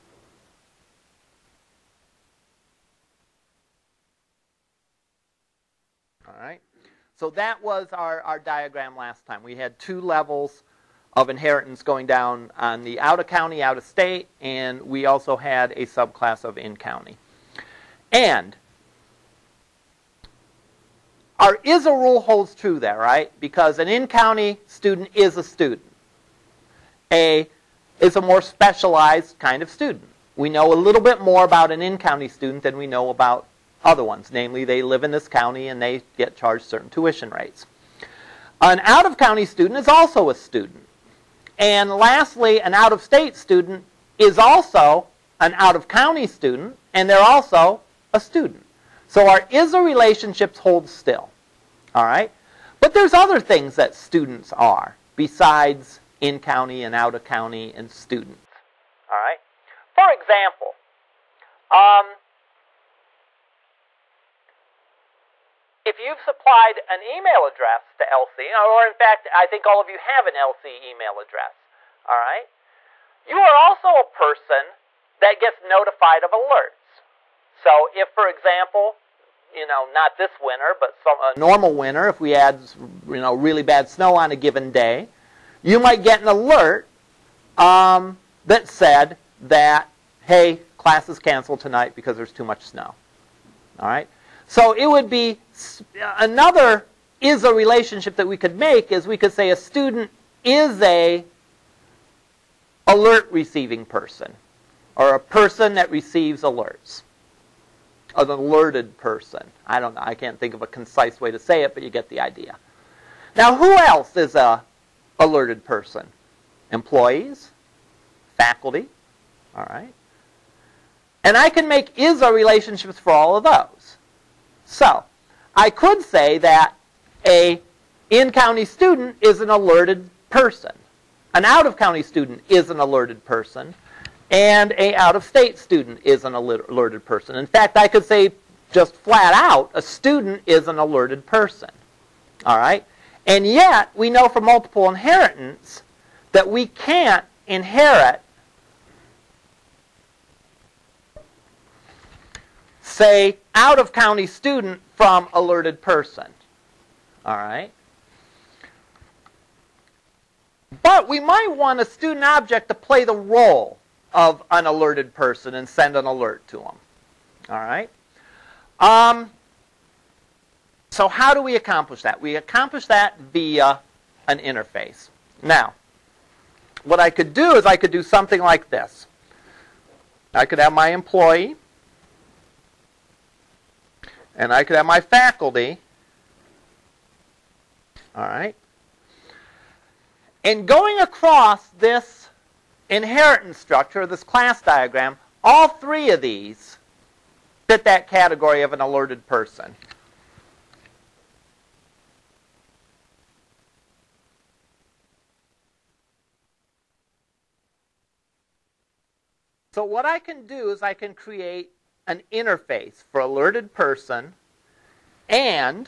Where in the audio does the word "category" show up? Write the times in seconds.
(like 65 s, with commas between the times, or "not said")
198 s.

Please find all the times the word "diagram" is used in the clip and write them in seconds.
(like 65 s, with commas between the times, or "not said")
8 s, 194 s.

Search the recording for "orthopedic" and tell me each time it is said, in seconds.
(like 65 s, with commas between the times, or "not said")
not said.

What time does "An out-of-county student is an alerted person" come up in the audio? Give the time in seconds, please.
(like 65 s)
131 s.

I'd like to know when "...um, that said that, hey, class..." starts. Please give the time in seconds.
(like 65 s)
87 s.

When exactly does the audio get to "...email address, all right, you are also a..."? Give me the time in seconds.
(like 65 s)
70 s.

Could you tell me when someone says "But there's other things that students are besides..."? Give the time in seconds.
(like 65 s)
52 s.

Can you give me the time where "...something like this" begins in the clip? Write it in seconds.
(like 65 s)
178 s.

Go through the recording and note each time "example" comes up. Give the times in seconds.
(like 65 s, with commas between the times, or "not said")
60 s, 78 s.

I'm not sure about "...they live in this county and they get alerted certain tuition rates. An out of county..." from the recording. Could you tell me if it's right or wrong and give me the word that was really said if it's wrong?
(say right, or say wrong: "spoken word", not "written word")
wrong: "charged", not "alerted".